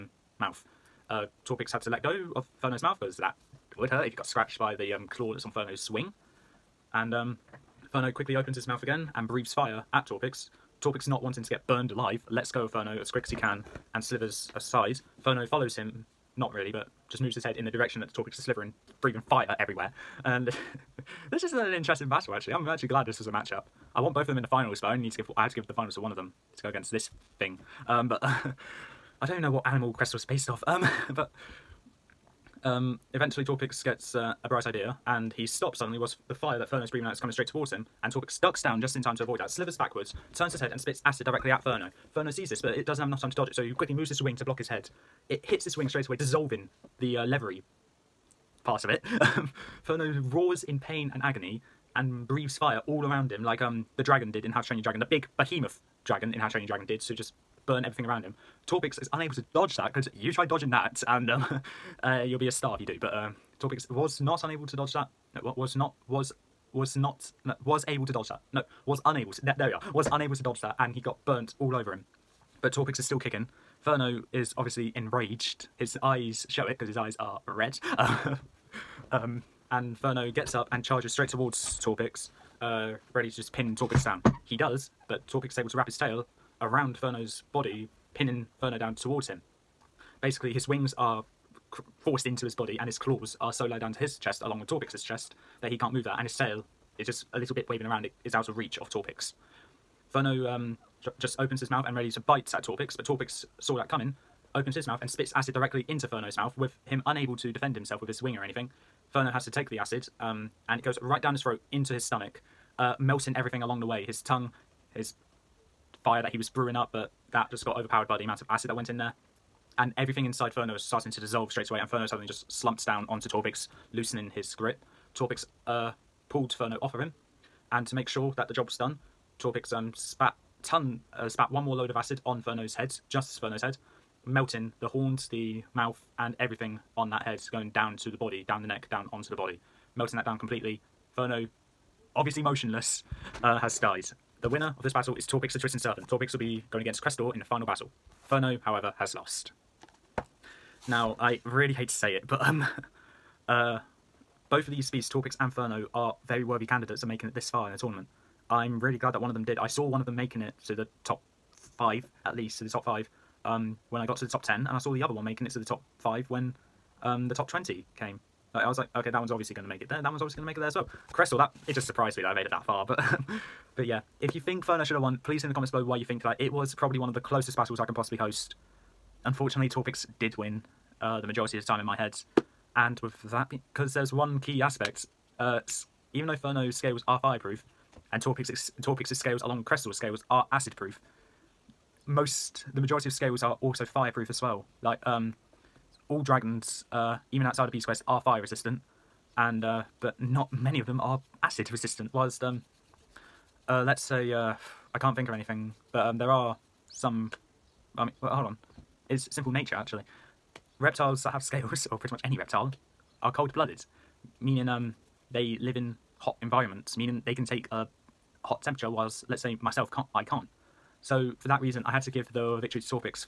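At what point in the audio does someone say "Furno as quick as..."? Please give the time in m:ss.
0:12.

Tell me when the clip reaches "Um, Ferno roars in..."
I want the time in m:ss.
0:49.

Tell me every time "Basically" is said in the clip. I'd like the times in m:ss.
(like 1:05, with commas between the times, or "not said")
1:30.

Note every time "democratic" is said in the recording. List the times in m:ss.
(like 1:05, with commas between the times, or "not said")
not said.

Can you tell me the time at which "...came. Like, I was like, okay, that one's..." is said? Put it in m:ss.
2:47.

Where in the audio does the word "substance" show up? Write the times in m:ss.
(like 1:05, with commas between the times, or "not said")
not said.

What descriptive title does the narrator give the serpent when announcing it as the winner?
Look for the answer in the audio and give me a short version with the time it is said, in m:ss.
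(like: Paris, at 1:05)
the Twisting Serpent, at 2:25.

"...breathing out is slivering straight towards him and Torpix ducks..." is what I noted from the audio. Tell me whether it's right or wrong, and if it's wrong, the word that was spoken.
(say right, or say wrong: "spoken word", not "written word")
wrong: "coming", not "slivering".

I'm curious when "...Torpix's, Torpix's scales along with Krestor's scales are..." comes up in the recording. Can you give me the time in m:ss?
3:08.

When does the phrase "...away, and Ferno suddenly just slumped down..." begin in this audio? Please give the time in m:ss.
2:01.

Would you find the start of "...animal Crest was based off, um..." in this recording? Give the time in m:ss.
0:29.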